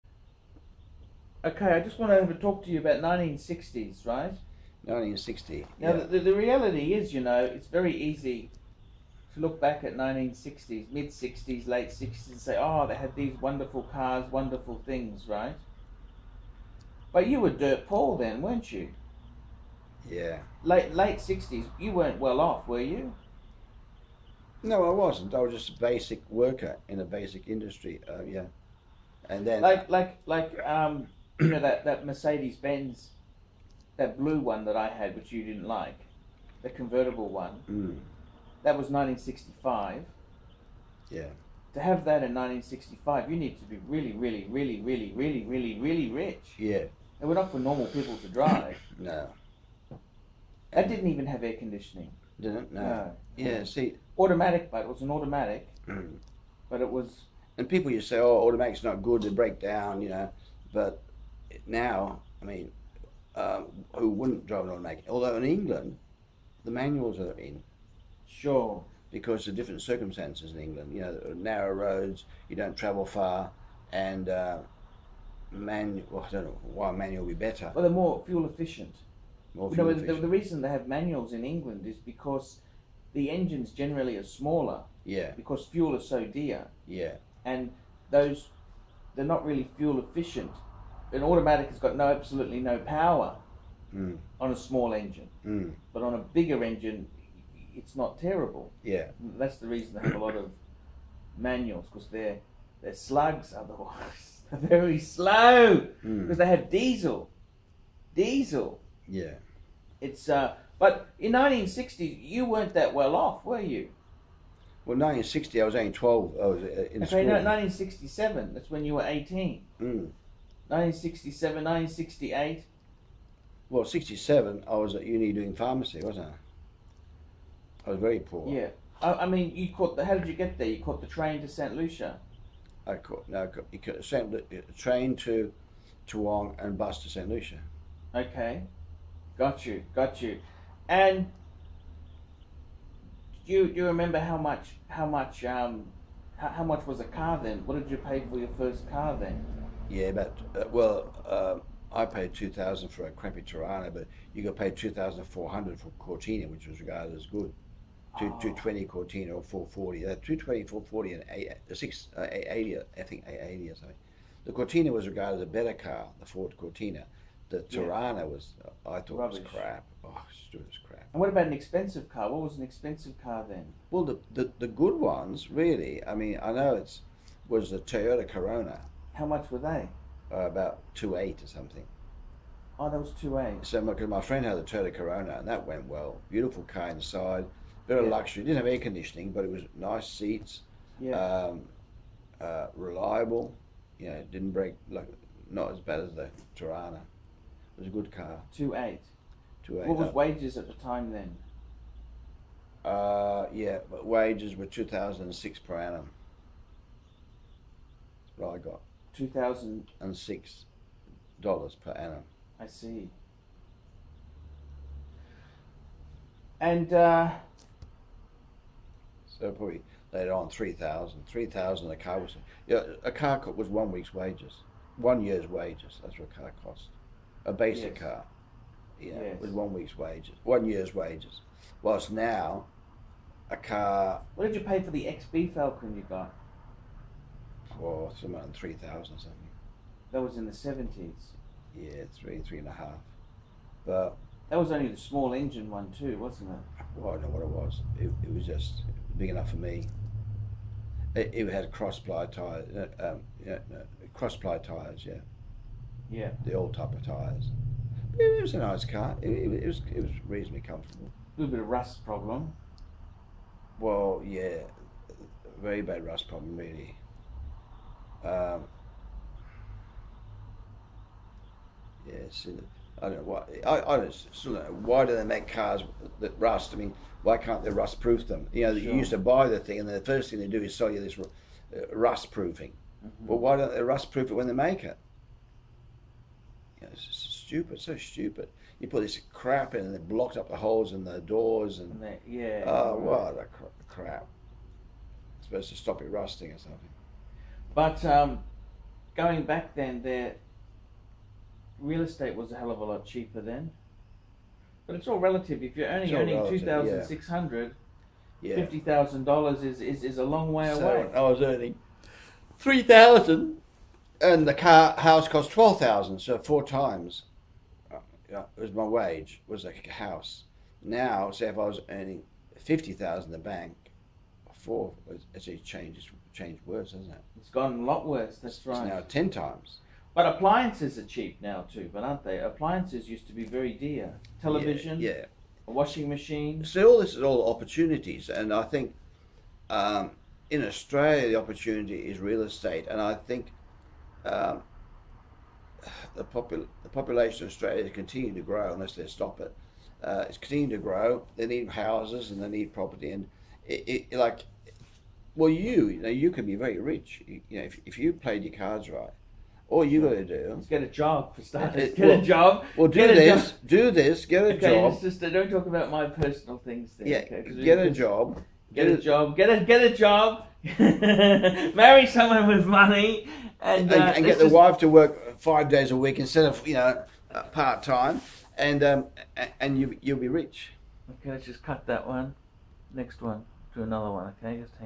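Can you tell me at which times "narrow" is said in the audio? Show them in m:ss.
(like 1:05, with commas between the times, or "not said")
1:11.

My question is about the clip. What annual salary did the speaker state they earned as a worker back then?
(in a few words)
$2,006.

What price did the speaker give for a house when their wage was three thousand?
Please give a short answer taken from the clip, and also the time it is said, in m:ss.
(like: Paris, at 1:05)
$12,000, at 5:15.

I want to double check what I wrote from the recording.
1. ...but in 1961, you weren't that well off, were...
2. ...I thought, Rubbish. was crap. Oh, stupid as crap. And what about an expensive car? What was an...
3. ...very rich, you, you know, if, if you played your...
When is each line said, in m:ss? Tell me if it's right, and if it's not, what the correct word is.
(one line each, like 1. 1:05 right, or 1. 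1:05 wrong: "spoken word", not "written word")
1. 1:50 wrong: "1960", not "1961"
2. 2:48 right
3. 5:56 right.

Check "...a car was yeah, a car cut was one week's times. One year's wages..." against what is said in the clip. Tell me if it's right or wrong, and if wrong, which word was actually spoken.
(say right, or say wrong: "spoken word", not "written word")
wrong: "wages", not "times".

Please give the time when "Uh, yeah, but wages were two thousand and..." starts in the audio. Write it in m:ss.
3:22.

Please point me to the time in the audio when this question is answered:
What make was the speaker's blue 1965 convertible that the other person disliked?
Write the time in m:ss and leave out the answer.
0:32.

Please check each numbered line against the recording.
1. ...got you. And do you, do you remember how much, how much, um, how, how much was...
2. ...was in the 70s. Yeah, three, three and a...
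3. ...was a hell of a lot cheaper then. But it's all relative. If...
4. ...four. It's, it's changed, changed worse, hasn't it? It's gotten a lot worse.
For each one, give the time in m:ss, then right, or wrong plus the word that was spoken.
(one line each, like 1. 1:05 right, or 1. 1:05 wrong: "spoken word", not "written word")
1. 2:19 right
2. 4:00 right
3. 5:02 right
4. 5:24 right.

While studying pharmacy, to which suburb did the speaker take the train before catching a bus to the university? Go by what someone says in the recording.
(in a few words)
Toowong.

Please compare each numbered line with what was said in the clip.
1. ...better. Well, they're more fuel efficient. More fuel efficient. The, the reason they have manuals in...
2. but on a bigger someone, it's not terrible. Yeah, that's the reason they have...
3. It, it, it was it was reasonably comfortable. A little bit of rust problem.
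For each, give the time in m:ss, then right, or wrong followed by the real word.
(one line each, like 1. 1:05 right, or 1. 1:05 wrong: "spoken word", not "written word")
1. 1:17 right
2. 1:35 wrong: "engine", not "someone"
3. 4:19 right.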